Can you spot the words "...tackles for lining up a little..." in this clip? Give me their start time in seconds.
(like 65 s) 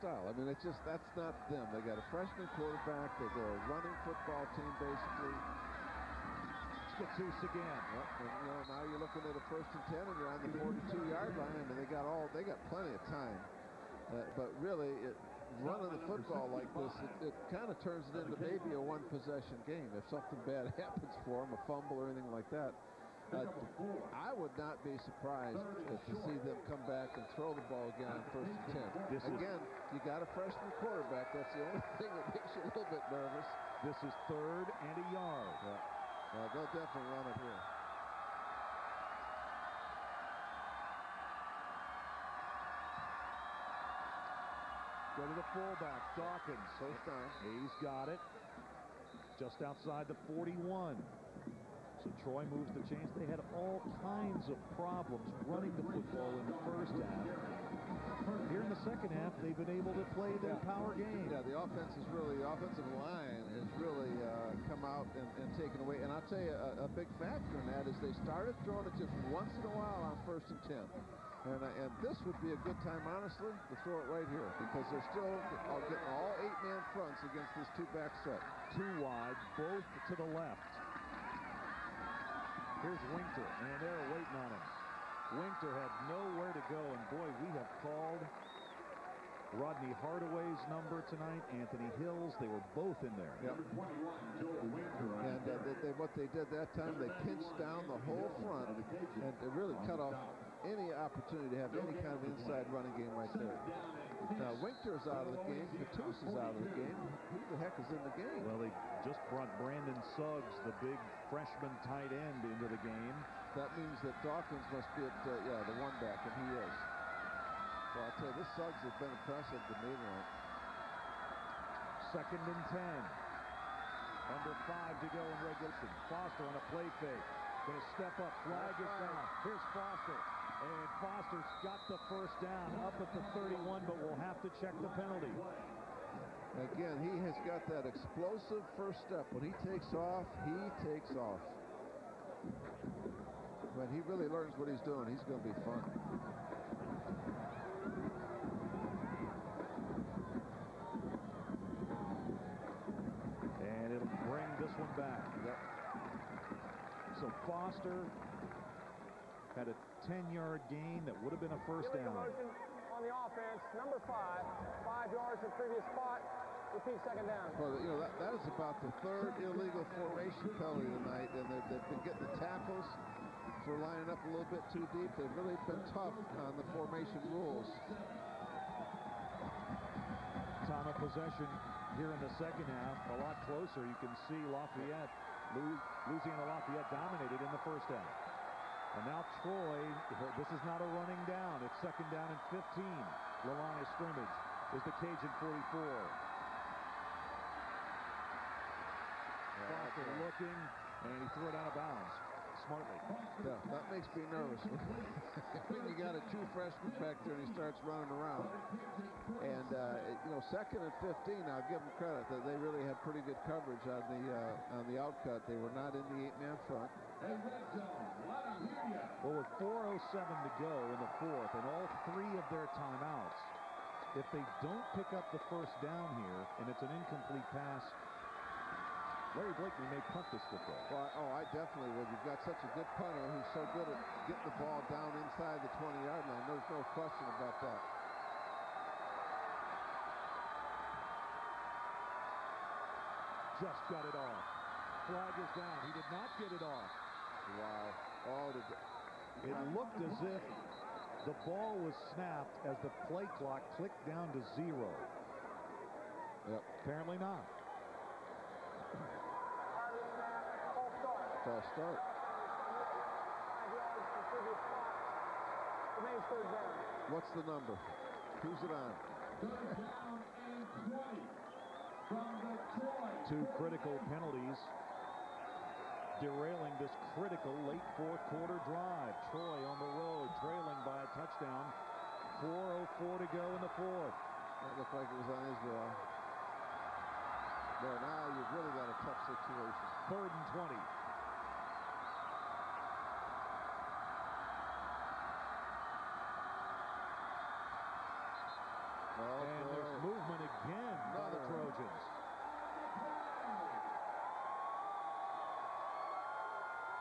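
172 s.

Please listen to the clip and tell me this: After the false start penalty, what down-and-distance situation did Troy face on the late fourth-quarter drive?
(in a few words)
Third and 20.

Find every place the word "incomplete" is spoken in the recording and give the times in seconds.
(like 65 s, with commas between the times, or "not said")
226 s.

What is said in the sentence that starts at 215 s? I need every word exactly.
They were not in the eight-man front.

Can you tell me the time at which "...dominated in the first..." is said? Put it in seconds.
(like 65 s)
186 s.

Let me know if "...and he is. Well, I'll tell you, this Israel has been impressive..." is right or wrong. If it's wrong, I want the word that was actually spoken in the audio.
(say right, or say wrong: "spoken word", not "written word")
wrong: "Suggs", not "Israel".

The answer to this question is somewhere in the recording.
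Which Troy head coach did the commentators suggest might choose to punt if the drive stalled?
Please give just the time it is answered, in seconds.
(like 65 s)
229 s.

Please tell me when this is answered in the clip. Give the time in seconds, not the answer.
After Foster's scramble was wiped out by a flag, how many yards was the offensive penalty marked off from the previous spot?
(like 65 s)
164 s.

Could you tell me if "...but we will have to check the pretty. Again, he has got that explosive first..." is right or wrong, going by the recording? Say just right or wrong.
wrong.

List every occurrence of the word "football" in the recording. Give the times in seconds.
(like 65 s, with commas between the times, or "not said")
4 s, 16 s, 55 s, 230 s.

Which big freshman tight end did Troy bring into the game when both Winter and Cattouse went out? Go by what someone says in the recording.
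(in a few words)
Brandon Suggs.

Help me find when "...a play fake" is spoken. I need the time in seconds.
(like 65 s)
126 s.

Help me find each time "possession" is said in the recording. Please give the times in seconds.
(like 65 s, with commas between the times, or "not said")
18 s, 180 s.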